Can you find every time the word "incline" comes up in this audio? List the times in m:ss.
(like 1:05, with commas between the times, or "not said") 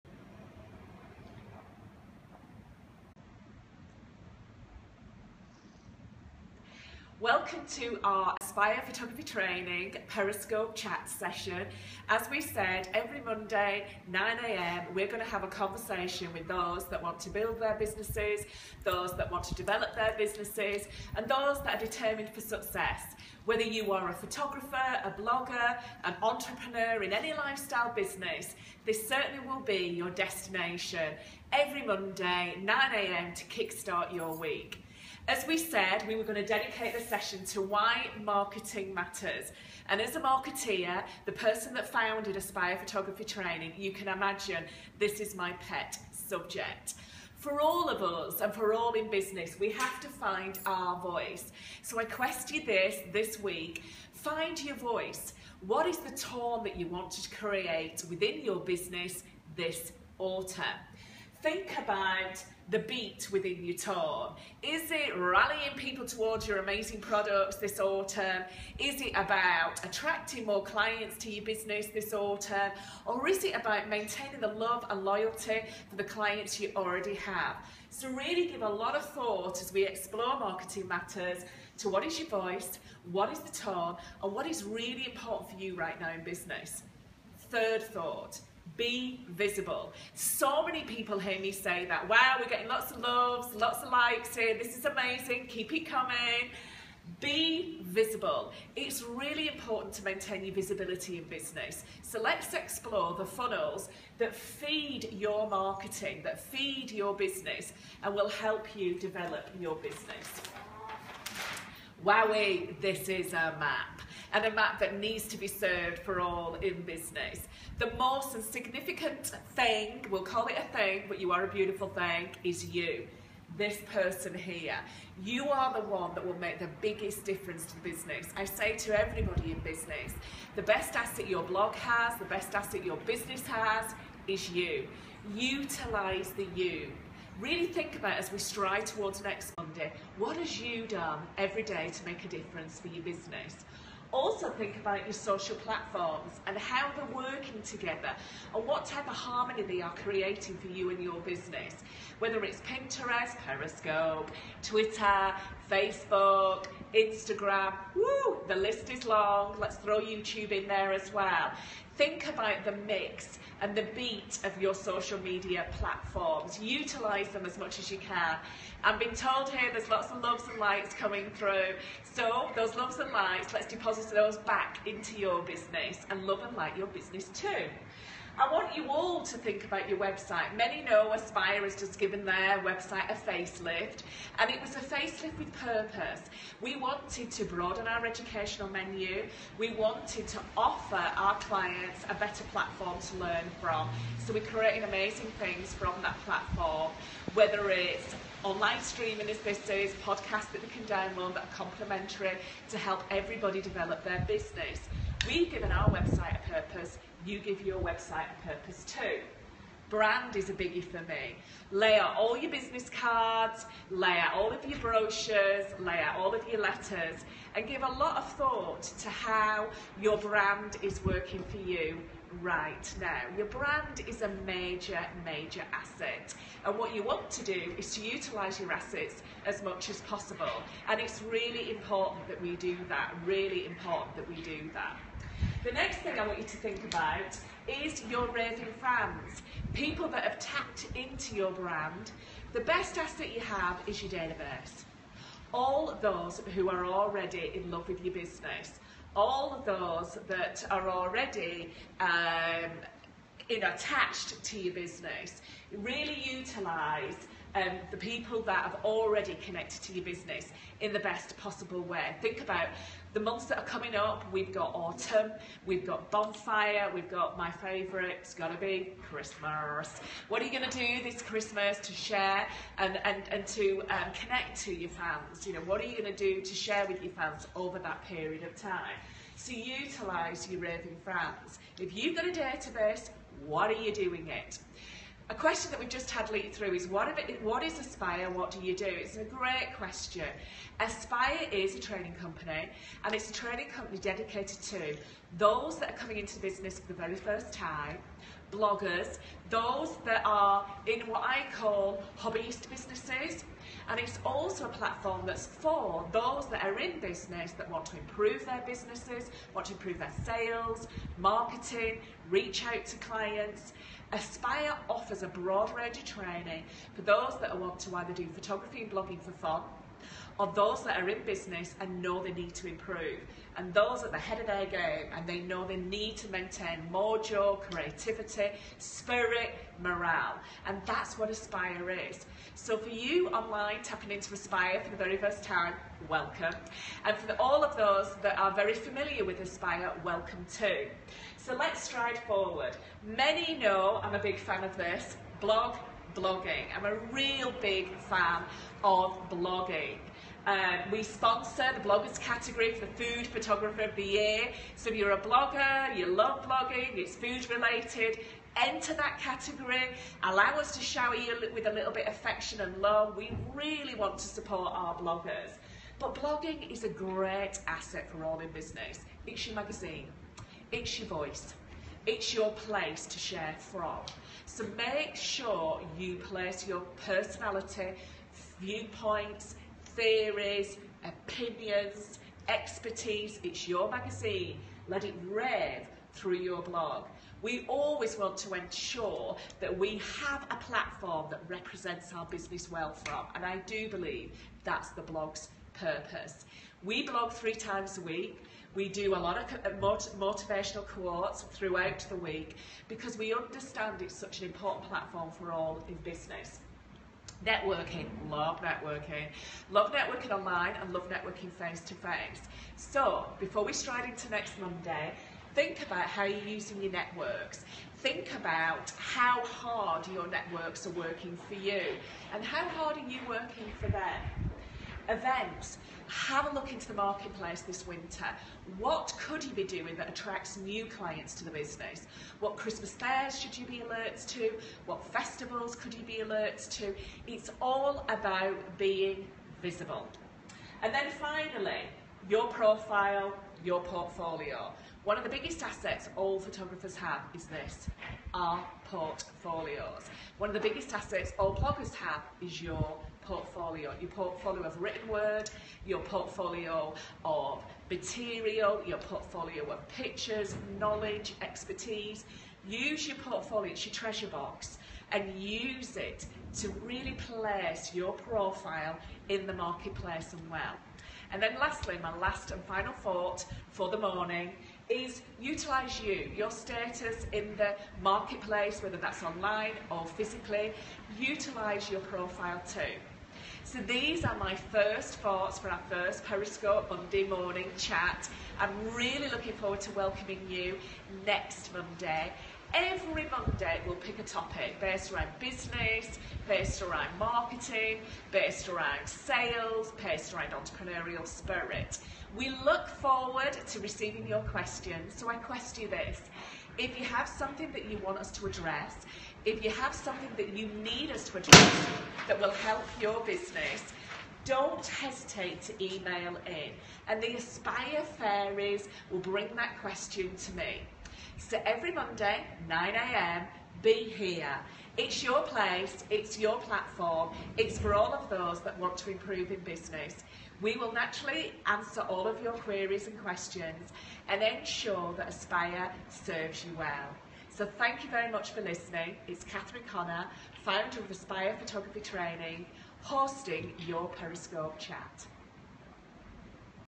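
not said.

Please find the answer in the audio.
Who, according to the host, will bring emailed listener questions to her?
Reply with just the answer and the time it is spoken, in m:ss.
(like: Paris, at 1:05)
the Aspire Fairies, at 8:37.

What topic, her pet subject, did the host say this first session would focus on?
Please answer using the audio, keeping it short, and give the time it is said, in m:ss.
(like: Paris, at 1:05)
why marketing matters, at 0:37.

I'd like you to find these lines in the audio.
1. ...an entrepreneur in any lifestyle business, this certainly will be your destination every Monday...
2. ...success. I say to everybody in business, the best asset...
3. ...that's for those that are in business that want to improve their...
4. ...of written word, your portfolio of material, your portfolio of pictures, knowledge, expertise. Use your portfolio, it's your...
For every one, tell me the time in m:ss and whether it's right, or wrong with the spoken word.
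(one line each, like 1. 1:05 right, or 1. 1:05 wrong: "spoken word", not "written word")
1. 0:26 right
2. 2:07 wrong: "business", not "success"
3. 5:05 right
4. 7:34 right.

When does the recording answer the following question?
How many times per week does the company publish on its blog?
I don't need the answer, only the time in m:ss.
6:37.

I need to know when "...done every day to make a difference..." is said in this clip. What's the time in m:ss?
2:20.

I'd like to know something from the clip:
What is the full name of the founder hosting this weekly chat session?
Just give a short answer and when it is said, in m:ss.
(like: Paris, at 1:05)
Catherine Connor, at 8:59.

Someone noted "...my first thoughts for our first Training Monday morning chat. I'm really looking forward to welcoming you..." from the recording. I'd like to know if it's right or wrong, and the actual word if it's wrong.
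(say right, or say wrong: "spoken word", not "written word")
wrong: "Periscope", not "Training".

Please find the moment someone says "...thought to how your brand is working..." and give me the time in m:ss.
3:38.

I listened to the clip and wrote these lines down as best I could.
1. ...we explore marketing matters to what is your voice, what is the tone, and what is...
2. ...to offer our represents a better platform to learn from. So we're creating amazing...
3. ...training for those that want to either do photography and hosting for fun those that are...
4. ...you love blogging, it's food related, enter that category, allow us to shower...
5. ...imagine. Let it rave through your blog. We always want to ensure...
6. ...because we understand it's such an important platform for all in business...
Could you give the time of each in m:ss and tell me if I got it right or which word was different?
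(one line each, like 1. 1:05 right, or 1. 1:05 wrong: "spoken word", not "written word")
1. 1:19 right
2. 3:10 wrong: "clients", not "represents"
3. 5:16 wrong: "blogging", not "hosting"
4. 5:55 right
5. 6:23 wrong: "magazine", not "imagine"
6. 6:42 right.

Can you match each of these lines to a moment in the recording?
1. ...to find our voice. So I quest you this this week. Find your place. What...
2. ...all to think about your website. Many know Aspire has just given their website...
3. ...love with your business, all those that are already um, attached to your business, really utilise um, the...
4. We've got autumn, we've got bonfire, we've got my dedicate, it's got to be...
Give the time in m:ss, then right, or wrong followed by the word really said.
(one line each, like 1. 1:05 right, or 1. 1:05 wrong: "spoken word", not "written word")
1. 0:50 wrong: "voice", not "place"
2. 2:58 right
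3. 4:07 right
4. 4:24 wrong: "favourite", not "dedicate".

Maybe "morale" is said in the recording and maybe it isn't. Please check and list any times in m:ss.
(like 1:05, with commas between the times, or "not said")
5:29.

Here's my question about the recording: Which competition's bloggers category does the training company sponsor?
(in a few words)
Food Photographer of the Year.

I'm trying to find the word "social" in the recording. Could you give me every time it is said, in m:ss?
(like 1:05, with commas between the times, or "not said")
2:25, 2:44.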